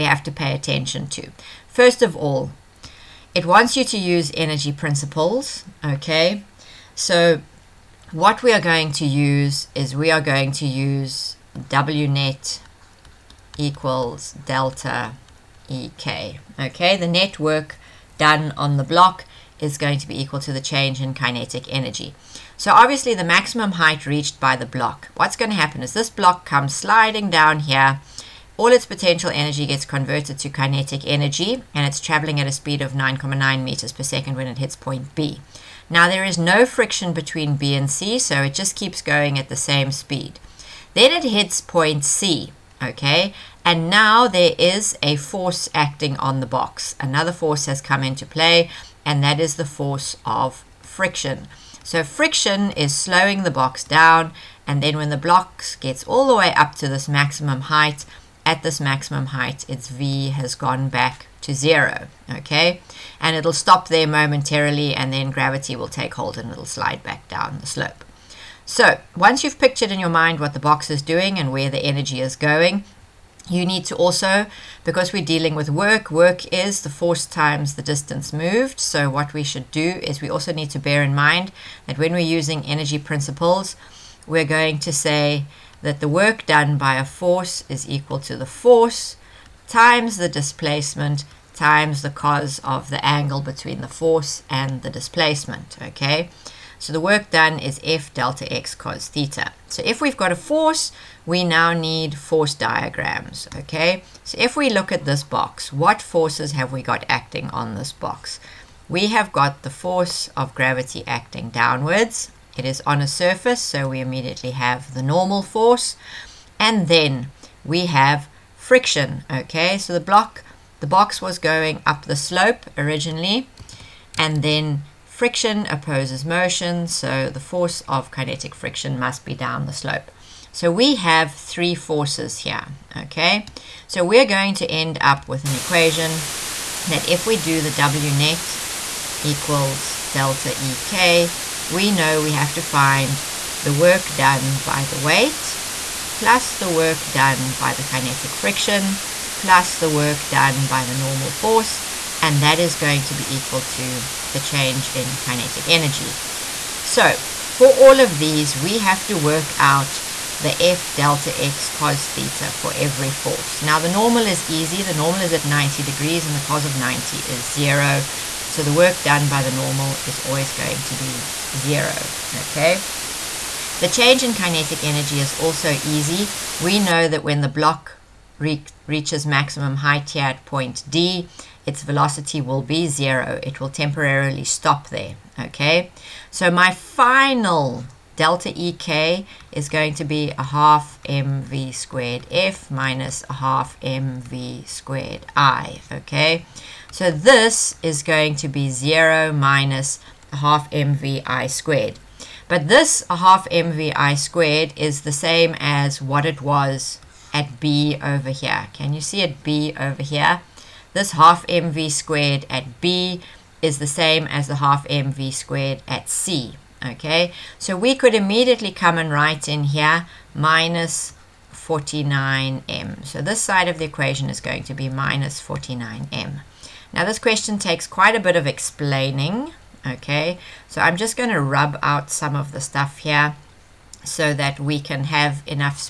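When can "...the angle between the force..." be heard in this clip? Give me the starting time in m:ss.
1:32.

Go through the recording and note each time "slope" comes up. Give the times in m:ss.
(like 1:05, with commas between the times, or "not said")
1:07, 2:02, 2:09.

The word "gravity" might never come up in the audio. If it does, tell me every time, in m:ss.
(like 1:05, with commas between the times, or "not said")
1:05, 1:50.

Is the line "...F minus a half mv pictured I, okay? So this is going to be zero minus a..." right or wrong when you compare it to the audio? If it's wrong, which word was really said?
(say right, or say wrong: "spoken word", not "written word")
wrong: "squared", not "pictured".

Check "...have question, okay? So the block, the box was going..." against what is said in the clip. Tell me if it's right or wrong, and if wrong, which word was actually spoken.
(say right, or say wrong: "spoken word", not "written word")
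wrong: "friction", not "question".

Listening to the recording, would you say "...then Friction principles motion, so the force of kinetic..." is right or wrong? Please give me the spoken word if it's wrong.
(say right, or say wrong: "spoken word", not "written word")
wrong: "opposes", not "principles".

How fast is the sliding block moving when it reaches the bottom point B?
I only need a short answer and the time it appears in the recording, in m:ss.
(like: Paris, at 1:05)
9.9 m/s, at 0:32.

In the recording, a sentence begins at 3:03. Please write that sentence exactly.
It will temporarily stop there, okay?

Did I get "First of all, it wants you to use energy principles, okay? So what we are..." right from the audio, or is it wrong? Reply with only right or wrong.
right.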